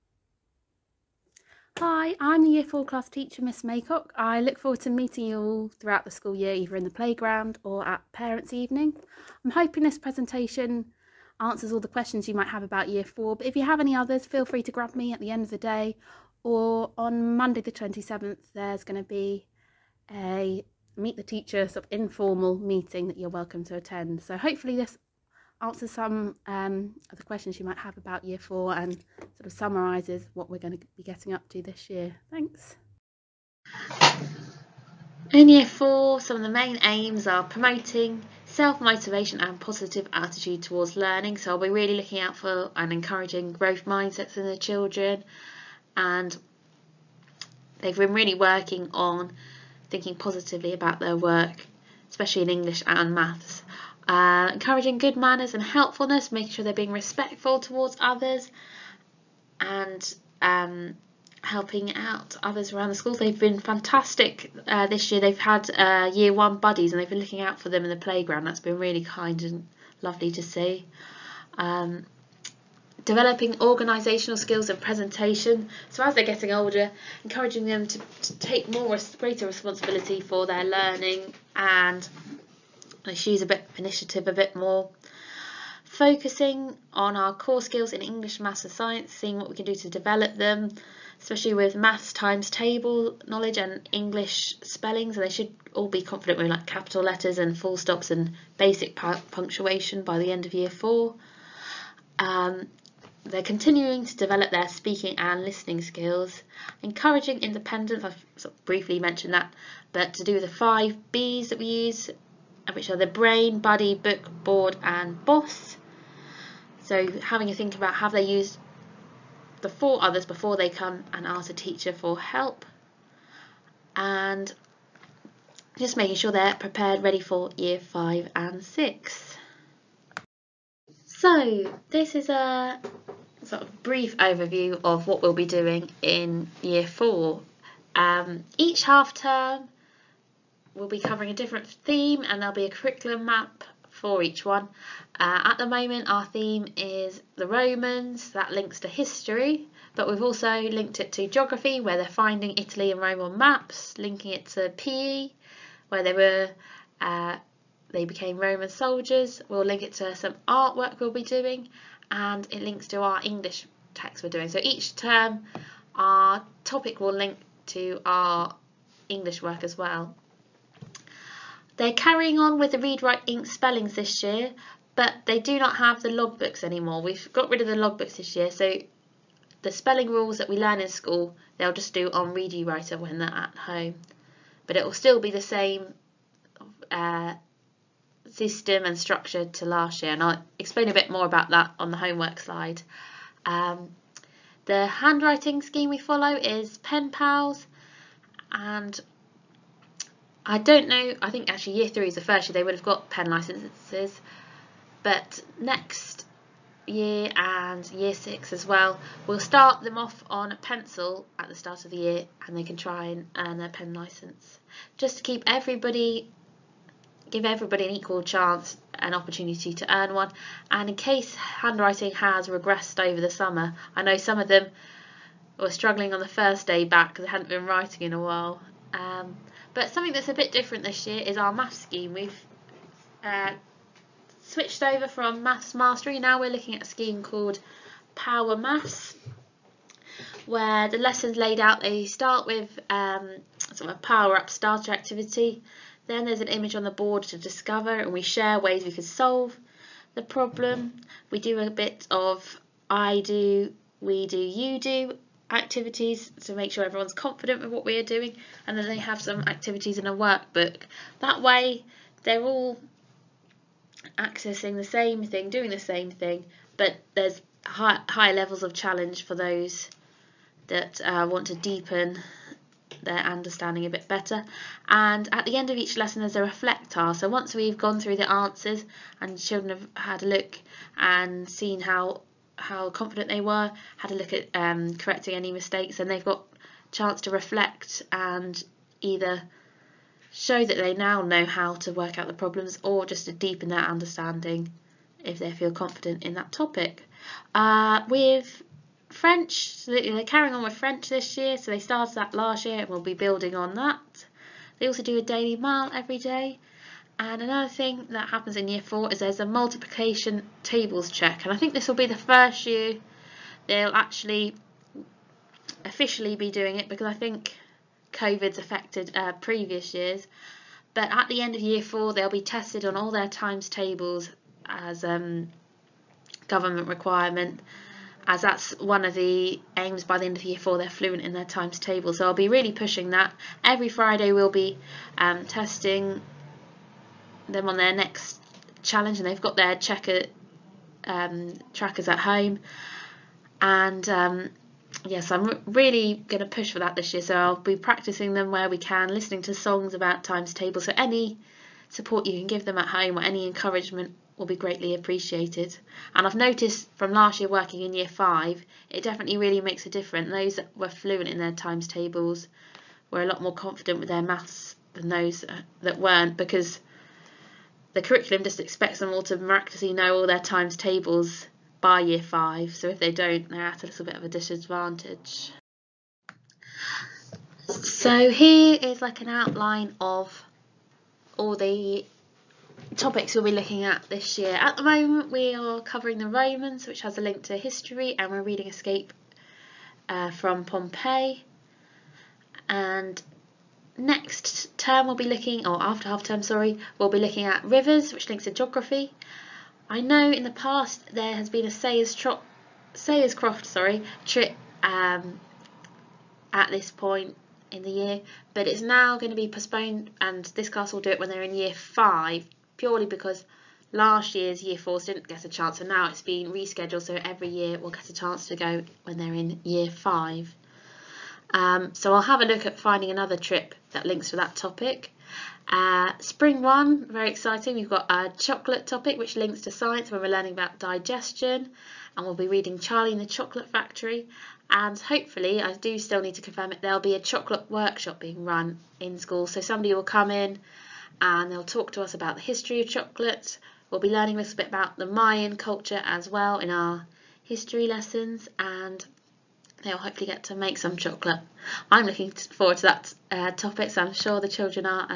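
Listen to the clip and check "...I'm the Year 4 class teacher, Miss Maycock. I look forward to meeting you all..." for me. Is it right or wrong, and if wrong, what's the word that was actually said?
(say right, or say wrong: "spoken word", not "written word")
right.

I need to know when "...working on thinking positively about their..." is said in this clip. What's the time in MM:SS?
00:48.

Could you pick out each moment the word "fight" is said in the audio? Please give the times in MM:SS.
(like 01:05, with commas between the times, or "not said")
not said.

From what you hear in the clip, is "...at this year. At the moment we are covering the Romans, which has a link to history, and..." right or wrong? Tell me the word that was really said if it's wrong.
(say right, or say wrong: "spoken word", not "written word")
right.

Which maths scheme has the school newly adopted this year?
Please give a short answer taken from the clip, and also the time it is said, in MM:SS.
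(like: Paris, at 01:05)
Power Maths, at 03:58.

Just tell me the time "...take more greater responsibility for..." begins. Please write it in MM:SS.
01:18.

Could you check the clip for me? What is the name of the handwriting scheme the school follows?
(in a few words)
Penpals.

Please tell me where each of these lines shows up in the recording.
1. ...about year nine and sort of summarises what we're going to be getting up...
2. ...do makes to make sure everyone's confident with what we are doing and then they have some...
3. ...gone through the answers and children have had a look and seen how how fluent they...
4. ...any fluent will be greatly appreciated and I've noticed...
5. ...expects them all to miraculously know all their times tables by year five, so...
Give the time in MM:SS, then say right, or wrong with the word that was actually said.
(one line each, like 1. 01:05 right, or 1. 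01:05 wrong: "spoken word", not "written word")
1. 00:27 wrong: "four", not "nine"
2. 04:14 wrong: "activities", not "makes"
3. 04:37 wrong: "confident", not "fluent"
4. 05:53 wrong: "encouragement", not "fluent"
5. 06:08 right.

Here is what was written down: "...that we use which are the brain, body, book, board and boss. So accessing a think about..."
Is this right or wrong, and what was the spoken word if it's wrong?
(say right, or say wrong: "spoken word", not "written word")
wrong: "having", not "accessing".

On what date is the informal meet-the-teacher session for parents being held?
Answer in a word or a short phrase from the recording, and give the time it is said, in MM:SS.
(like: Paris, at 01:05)
Monday the 27th, at 00:17.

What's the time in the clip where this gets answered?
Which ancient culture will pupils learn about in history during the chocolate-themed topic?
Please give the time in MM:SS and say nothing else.
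07:25.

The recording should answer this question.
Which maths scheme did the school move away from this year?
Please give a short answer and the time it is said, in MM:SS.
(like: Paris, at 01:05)
Maths Mastery, at 03:55.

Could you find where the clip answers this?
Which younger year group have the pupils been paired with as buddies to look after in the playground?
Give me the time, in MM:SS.
01:06.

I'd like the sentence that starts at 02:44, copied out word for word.
So each term our topic will link to our English work as well.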